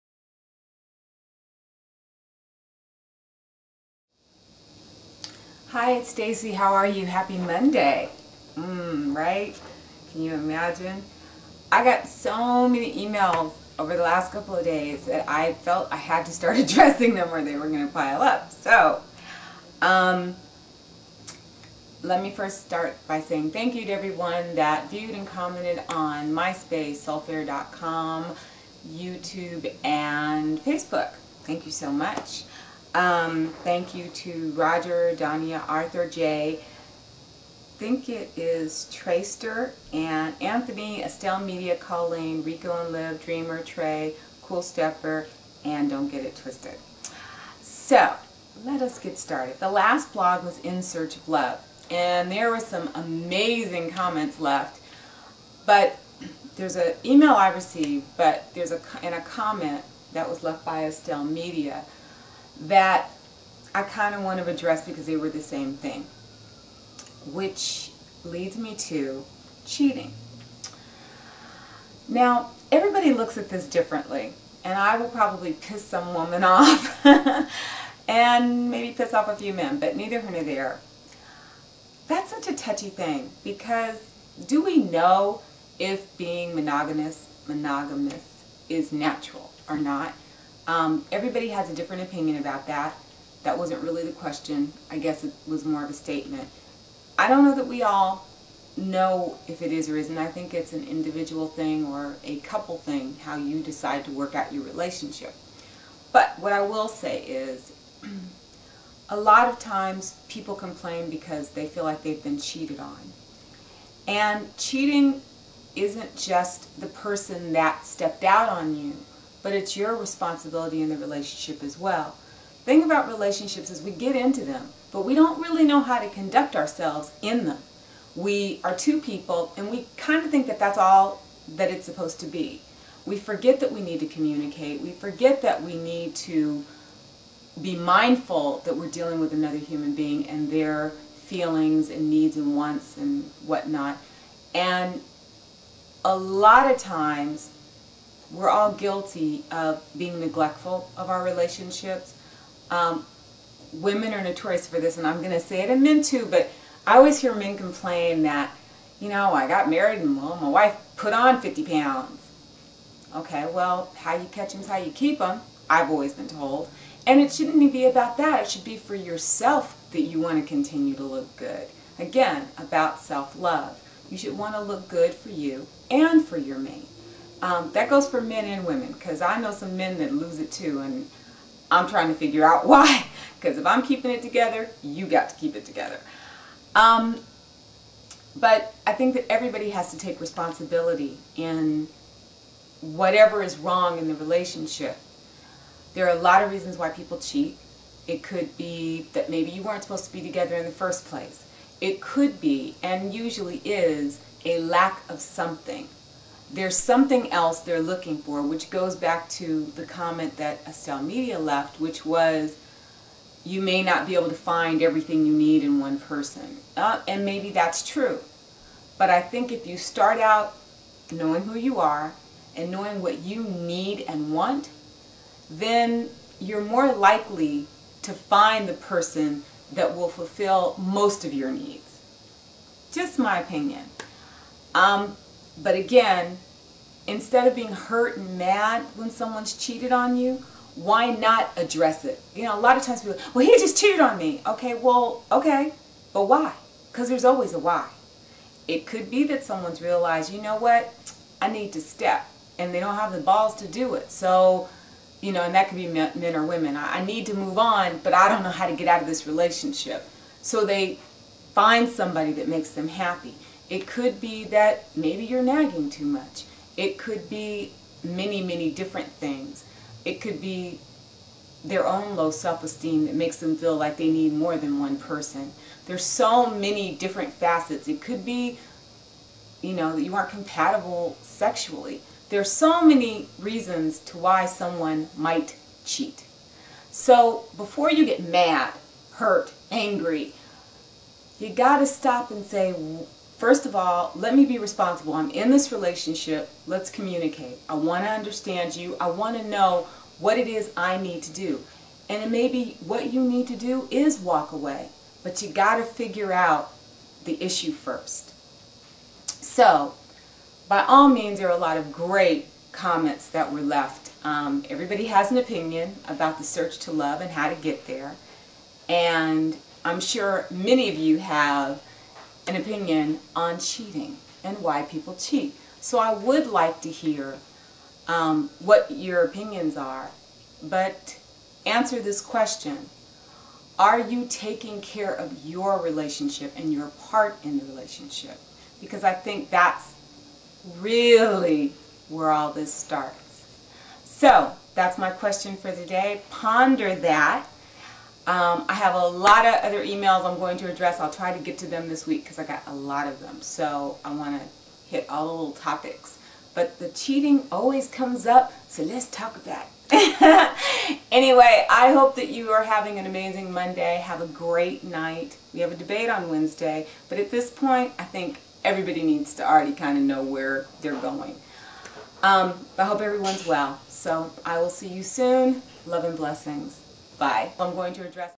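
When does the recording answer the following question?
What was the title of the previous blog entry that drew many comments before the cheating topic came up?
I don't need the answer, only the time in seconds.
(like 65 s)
50 s.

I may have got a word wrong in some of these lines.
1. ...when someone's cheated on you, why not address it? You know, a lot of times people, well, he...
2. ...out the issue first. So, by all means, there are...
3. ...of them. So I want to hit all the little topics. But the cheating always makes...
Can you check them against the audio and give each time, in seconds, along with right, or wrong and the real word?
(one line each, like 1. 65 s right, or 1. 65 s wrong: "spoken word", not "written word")
1. 238 s right
2. 306 s right
3. 353 s wrong: "comes", not "makes".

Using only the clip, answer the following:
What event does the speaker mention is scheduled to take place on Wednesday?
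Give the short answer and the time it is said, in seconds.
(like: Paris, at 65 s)
A debate, at 365 s.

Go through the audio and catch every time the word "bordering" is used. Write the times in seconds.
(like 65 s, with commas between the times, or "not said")
not said.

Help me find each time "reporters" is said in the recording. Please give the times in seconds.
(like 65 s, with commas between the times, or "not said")
not said.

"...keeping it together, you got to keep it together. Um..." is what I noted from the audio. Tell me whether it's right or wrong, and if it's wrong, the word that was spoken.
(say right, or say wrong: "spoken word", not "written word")
right.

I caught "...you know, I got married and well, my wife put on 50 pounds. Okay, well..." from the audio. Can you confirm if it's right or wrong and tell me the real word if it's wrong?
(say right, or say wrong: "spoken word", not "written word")
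right.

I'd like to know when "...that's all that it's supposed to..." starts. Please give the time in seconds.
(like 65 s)
130 s.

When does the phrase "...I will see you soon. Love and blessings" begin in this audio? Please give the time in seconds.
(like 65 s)
374 s.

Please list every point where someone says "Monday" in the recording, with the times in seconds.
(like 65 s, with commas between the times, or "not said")
7 s, 363 s.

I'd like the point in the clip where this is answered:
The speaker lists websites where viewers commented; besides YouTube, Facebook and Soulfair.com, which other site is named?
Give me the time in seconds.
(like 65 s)
26 s.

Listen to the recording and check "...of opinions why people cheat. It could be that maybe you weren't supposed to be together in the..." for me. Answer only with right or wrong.
wrong.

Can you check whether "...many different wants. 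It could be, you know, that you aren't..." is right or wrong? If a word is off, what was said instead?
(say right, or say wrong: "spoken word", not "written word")
wrong: "facets", not "wants".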